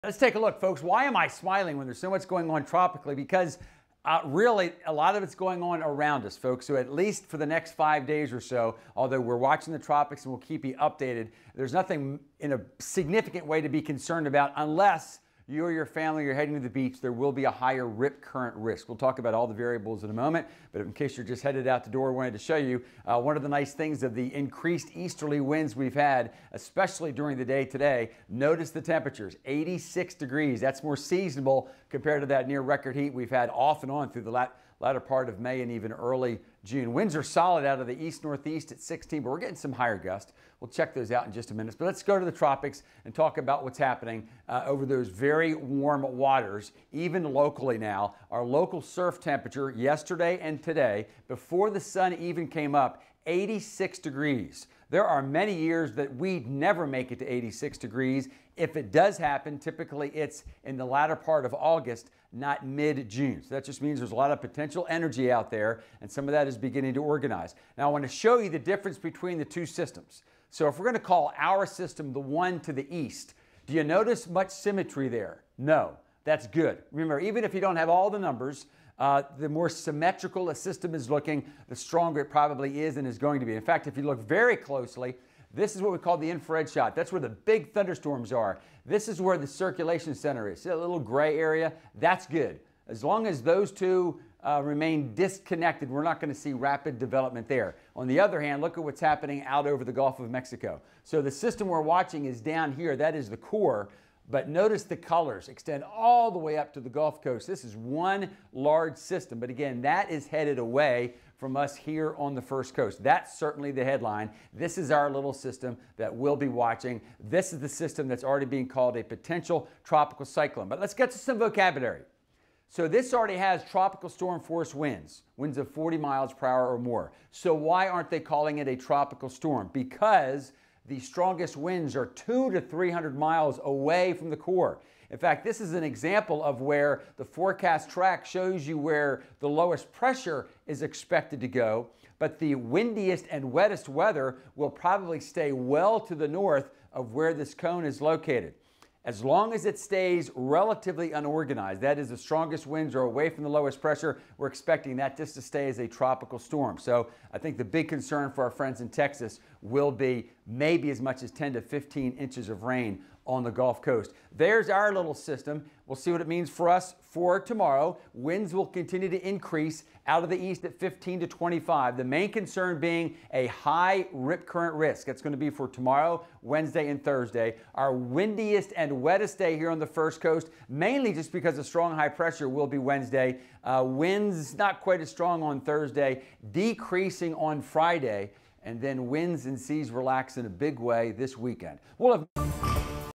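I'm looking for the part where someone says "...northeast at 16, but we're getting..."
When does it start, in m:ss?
0:38.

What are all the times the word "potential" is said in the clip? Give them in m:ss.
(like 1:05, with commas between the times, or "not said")
1:04, 1:59.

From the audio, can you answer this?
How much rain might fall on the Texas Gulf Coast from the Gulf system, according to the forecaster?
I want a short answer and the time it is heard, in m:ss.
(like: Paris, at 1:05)
10 to 15 inches, at 2:41.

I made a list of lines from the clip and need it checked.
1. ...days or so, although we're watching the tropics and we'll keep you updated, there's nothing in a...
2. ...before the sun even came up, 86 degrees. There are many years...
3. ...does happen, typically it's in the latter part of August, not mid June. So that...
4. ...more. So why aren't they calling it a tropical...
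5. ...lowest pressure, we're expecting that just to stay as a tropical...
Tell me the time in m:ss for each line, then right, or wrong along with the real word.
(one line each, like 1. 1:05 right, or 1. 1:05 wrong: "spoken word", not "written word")
1. 0:08 right
2. 0:51 right
3. 0:58 right
4. 2:06 right
5. 2:33 right.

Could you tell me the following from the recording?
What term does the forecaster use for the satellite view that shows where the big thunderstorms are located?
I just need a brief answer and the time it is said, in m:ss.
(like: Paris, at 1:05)
infrared shot, at 1:26.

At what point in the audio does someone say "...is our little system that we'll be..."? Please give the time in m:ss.
1:54.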